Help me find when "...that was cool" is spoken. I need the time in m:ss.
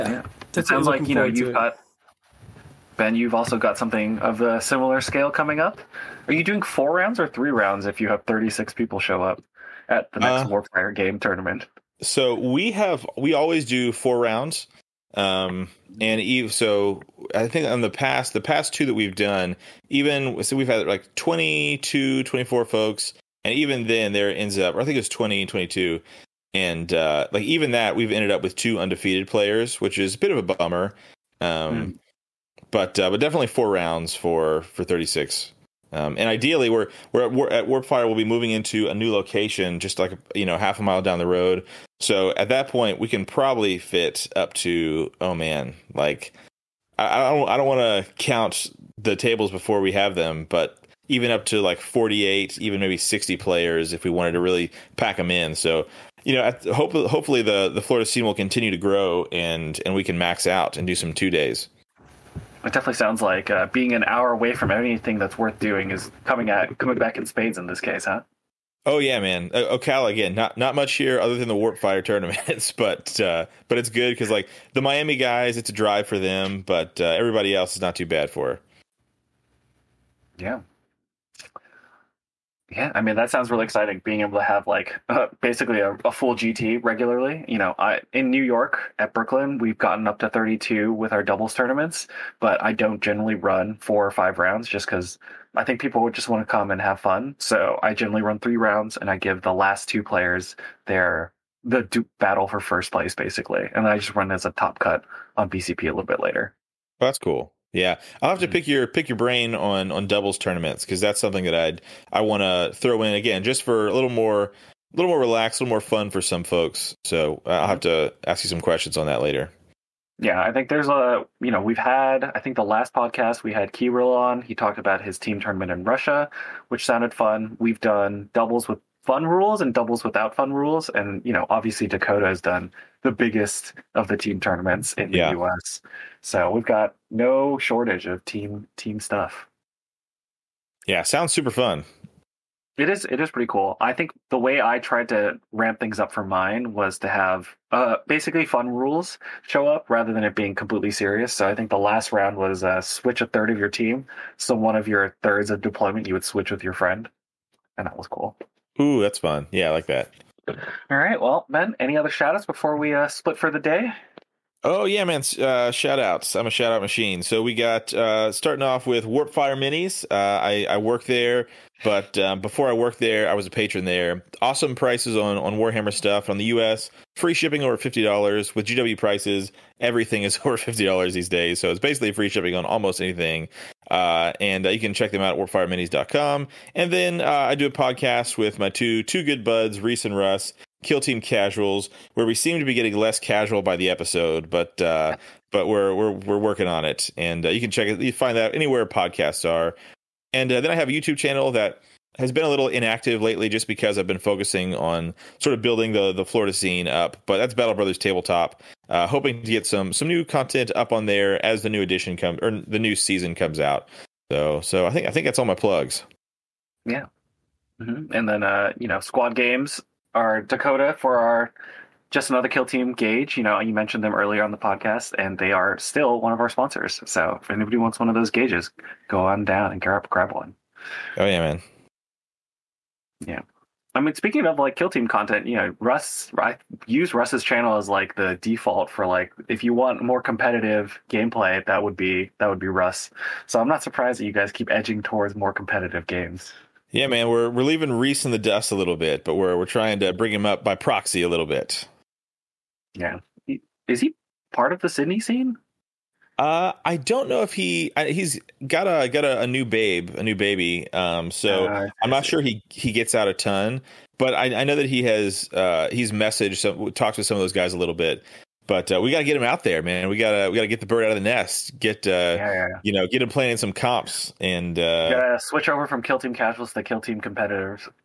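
2:37.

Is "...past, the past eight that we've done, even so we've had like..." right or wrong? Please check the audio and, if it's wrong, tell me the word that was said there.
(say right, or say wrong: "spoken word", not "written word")
wrong: "two", not "eight".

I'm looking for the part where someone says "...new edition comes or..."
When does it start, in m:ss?
3:31.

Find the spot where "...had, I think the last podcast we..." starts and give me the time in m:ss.
2:01.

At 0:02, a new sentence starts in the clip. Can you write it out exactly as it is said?
Ben, you've also got something of a similar scale coming up.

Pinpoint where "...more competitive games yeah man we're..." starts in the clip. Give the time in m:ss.
4:05.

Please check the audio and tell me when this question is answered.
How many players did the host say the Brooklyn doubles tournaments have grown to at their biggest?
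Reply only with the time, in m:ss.
1:30.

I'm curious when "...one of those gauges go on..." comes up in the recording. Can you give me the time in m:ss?
3:47.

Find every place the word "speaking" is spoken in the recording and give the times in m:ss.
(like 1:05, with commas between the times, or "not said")
3:54.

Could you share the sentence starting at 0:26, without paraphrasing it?
And uh, like even that, we've ended up with two undefeated players, which is a bit of a bummer.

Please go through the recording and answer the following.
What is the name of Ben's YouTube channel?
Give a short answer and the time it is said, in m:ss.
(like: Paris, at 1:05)
Battle Brothers Tabletop, at 3:27.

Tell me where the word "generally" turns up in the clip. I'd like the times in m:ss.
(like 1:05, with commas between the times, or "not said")
1:33, 1:37.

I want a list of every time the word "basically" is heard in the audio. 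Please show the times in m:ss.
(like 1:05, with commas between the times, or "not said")
1:25, 1:43, 2:28, 3:01.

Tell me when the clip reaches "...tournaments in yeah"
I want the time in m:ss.
2:14.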